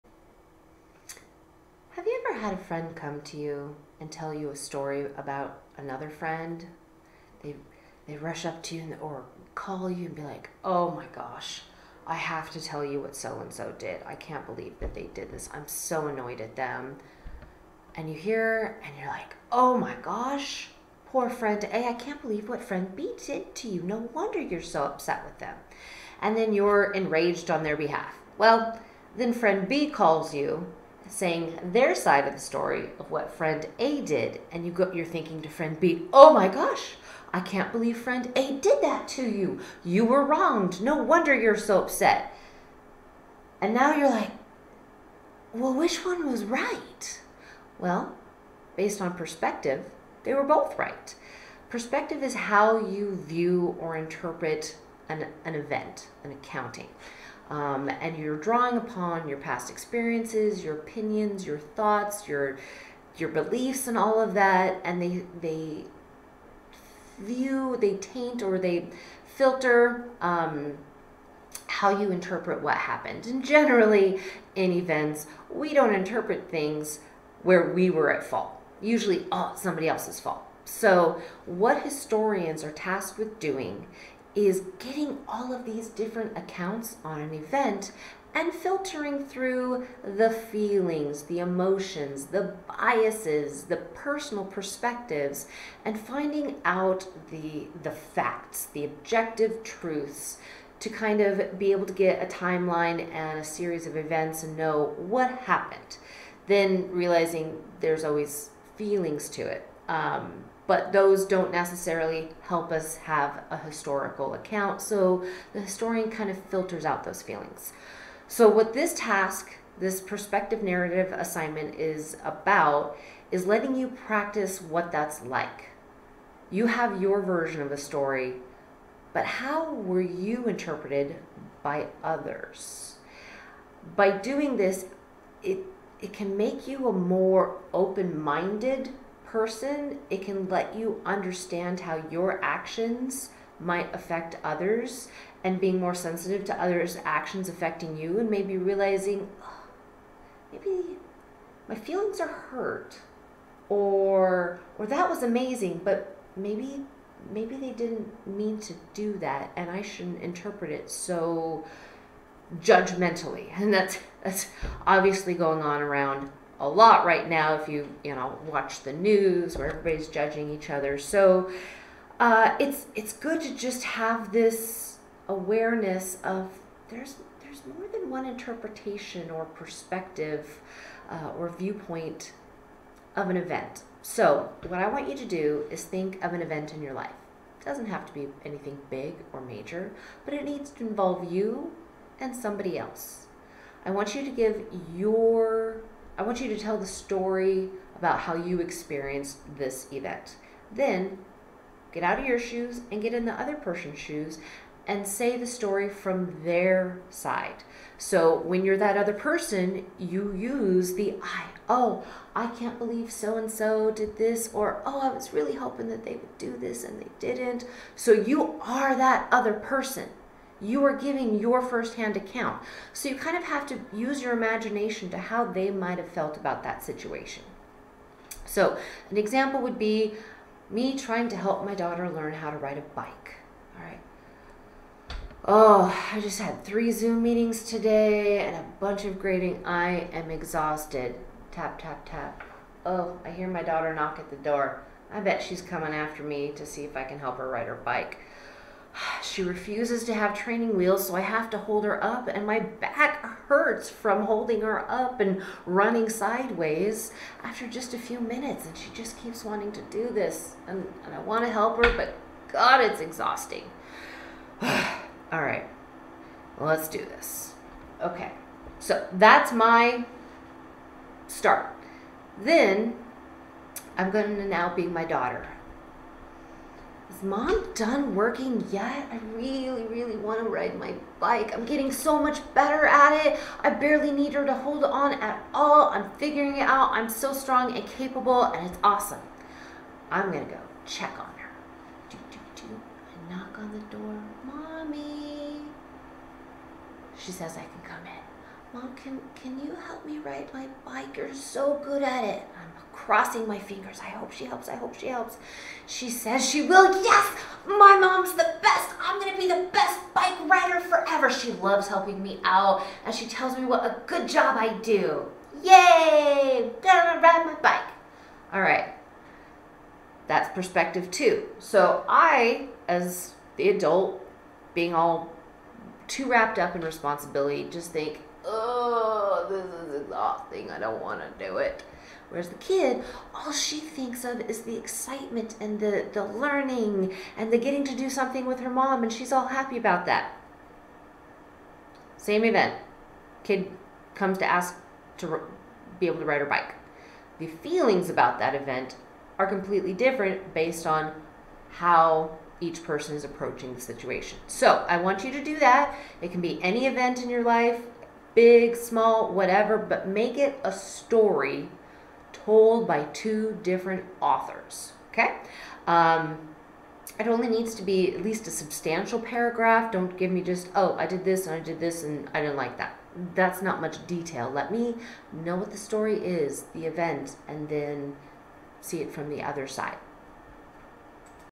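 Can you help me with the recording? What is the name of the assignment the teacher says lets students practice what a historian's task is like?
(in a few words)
Perspective narrative assignment.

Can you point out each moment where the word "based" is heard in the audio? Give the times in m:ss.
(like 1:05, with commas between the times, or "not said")
0:48, 5:50.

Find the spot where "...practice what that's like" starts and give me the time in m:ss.
2:03.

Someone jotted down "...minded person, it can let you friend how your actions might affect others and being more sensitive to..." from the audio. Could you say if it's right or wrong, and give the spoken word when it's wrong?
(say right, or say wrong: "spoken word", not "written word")
wrong: "understand", not "friend".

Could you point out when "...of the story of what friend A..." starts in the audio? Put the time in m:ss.
0:32.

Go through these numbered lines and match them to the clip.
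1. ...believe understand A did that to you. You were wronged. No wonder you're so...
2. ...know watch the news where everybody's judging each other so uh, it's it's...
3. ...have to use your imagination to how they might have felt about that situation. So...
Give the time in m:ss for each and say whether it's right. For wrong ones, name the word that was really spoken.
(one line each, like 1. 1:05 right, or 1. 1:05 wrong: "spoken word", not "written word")
1. 0:37 wrong: "friend", not "understand"
2. 2:48 right
3. 3:43 right.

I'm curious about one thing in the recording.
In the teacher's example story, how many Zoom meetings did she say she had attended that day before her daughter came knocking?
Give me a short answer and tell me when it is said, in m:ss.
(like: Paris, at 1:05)
3, at 3:56.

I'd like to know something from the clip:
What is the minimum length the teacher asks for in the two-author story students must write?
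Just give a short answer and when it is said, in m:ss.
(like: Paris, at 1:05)
A substantial paragraph, at 6:08.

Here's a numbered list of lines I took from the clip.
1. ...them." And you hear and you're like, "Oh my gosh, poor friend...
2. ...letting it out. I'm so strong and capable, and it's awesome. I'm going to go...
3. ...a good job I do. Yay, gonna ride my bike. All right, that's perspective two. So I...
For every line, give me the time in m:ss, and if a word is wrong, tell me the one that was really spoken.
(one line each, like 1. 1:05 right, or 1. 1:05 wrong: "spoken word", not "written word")
1. 0:16 right
2. 4:46 wrong: "figuring", not "letting"
3. 5:13 right.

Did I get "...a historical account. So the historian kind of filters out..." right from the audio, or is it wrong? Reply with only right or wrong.
right.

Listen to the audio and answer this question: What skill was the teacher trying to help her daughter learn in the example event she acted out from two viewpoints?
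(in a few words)
Ride a bike.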